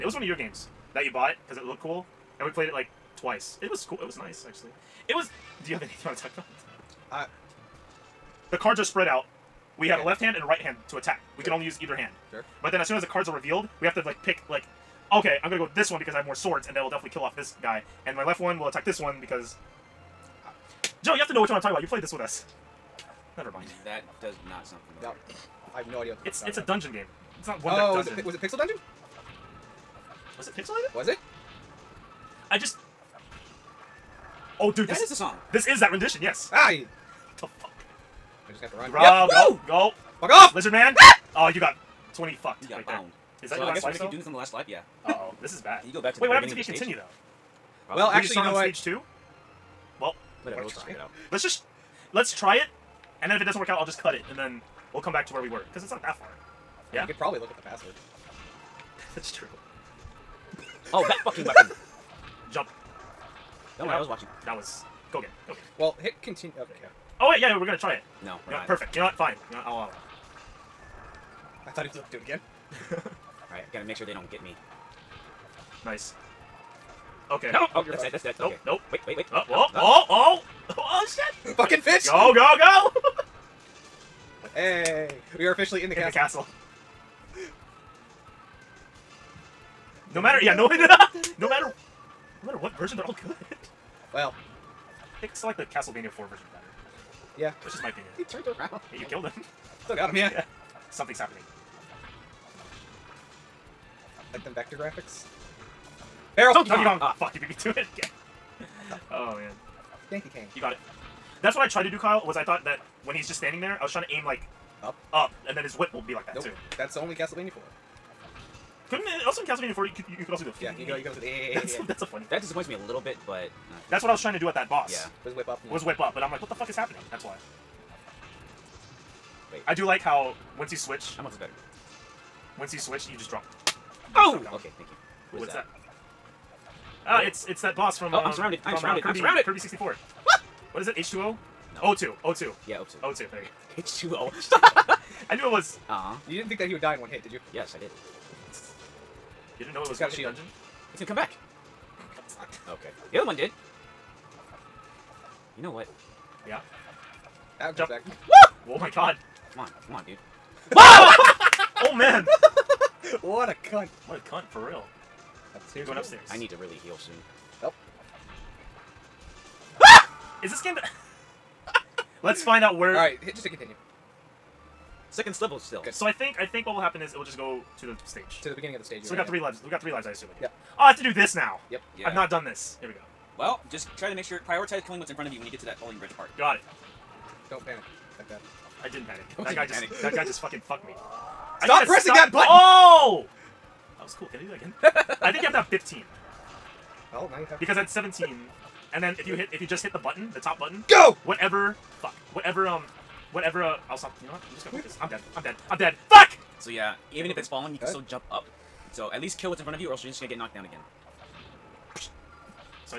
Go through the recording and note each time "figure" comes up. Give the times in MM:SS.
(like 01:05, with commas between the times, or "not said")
00:50.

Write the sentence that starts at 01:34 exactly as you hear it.
Well, think I still like the Castlevania 4 version better.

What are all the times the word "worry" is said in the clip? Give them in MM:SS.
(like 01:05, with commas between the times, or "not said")
01:03.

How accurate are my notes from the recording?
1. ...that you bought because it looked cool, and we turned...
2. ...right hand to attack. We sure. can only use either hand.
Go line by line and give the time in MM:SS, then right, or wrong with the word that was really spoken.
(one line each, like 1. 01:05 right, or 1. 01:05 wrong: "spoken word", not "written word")
1. 00:00 wrong: "played", not "turned"
2. 00:10 right.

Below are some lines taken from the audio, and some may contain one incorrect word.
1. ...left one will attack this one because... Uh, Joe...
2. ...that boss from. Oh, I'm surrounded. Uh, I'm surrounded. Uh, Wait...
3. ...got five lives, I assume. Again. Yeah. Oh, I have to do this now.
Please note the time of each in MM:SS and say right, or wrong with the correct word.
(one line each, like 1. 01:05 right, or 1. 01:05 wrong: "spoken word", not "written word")
1. 00:18 right
2. 02:17 wrong: "Kirby", not "Wait"
3. 02:59 wrong: "three", not "five".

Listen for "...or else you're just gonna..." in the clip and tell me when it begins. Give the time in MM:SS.
03:29.